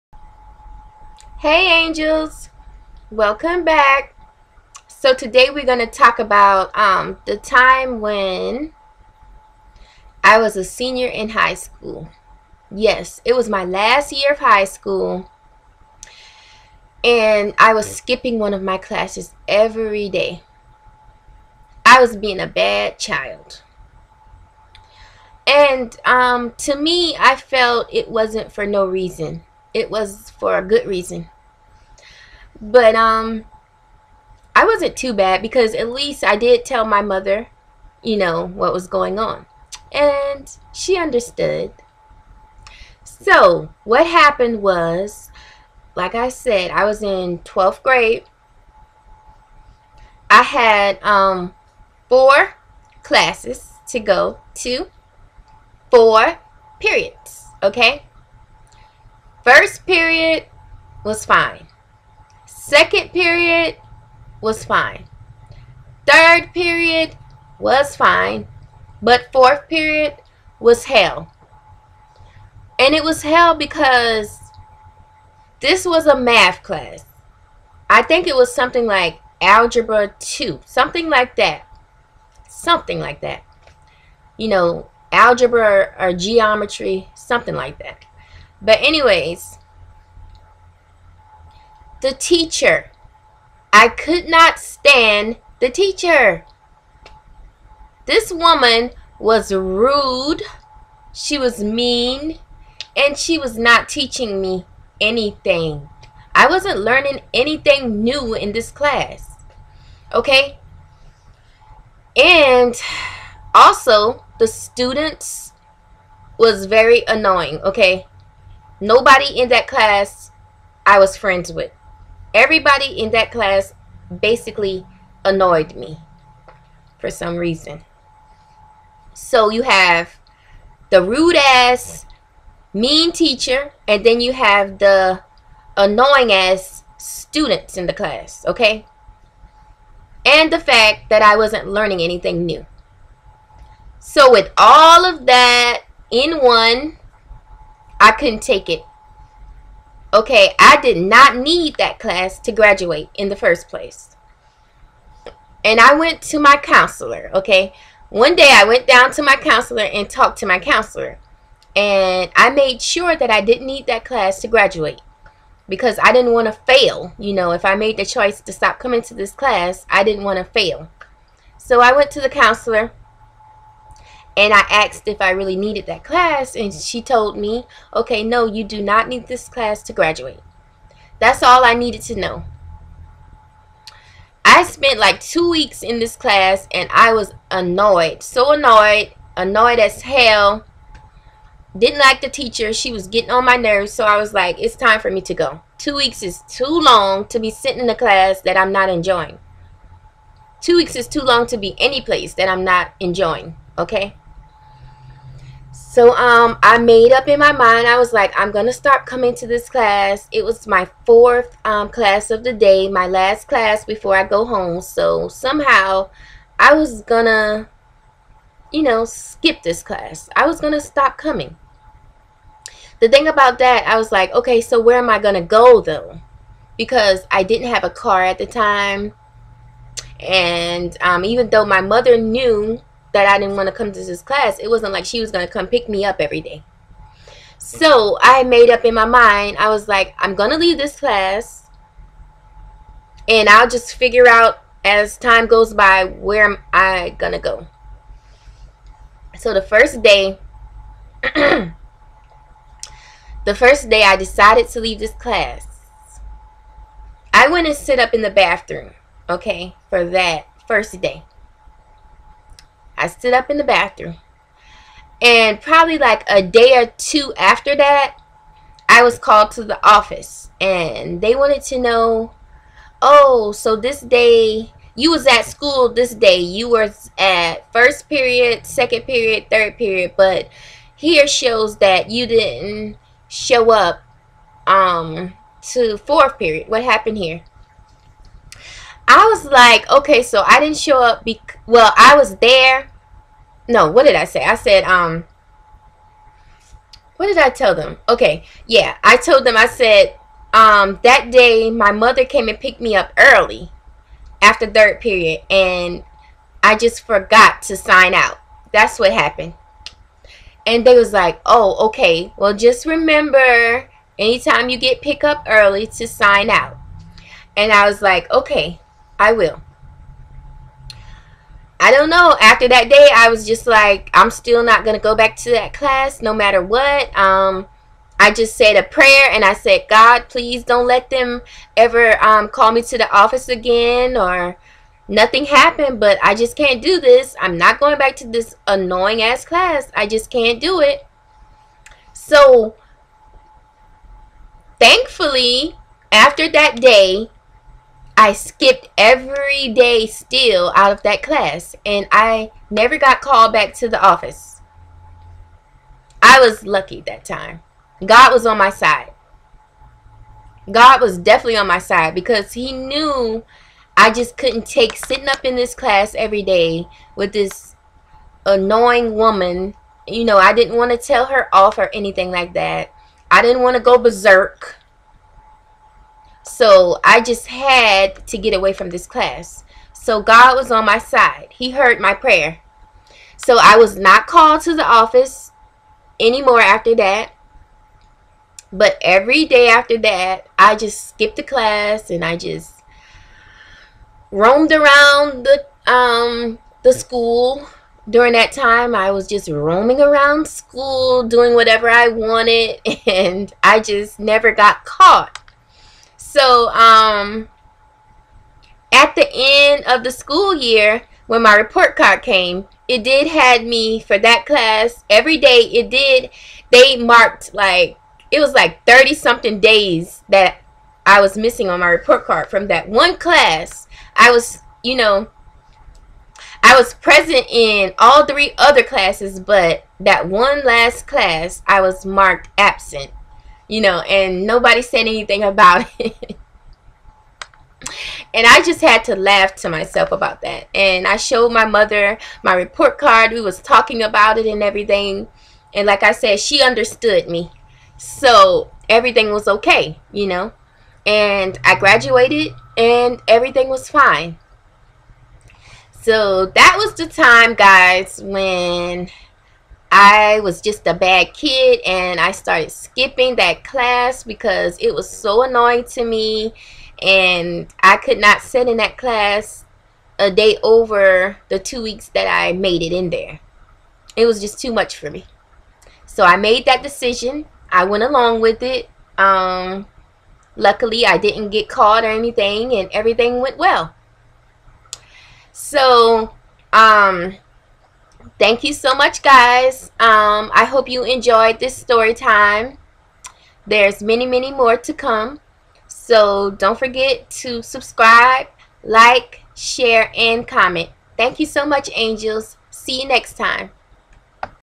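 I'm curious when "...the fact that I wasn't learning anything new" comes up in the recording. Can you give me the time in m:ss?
2:20.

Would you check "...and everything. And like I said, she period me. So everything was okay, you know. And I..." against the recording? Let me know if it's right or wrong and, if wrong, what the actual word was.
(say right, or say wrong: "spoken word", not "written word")
wrong: "understood", not "period".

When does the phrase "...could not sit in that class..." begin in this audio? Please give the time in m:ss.
7:47.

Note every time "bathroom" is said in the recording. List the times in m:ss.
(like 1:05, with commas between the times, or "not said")
4:18, 4:23.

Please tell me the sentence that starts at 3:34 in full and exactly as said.
So somehow I was going to, you know, skip this class.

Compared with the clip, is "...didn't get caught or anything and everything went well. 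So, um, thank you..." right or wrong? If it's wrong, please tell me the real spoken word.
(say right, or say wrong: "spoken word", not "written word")
right.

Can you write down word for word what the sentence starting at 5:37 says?
I'm not going back to this annoying ass class.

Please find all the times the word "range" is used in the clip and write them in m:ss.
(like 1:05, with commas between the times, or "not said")
not said.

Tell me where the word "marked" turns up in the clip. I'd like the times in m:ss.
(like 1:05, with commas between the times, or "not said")
6:56, 7:12.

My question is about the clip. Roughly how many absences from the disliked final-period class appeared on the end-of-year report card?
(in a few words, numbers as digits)
Thirty something.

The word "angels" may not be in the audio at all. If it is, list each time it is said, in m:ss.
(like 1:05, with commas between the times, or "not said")
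0:01, 8:21.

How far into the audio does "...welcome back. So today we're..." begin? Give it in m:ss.
0:03.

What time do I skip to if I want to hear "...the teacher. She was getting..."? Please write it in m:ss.
3:12.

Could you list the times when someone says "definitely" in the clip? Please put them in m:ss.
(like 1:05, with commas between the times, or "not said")
6:01.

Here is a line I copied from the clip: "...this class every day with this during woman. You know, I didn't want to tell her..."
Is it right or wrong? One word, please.
wrong.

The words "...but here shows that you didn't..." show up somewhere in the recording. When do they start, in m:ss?
4:40.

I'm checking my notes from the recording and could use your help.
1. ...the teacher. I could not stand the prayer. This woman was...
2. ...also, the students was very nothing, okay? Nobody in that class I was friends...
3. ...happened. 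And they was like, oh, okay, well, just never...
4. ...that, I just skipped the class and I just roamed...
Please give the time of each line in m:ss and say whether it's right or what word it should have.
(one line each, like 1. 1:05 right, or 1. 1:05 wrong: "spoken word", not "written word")
1. 1:32 wrong: "teacher", not "prayer"
2. 1:53 wrong: "annoying", not "nothing"
3. 5:09 wrong: "remember", not "never"
4. 6:29 right.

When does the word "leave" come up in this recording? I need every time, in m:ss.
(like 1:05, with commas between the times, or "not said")
4:00, 4:14.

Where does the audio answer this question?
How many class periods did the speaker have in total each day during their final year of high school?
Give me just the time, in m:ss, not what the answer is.
0:52.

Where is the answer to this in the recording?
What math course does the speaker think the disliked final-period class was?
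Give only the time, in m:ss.
1:19.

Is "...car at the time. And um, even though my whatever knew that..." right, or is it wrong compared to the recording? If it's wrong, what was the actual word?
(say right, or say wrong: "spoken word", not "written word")
wrong: "mother", not "whatever".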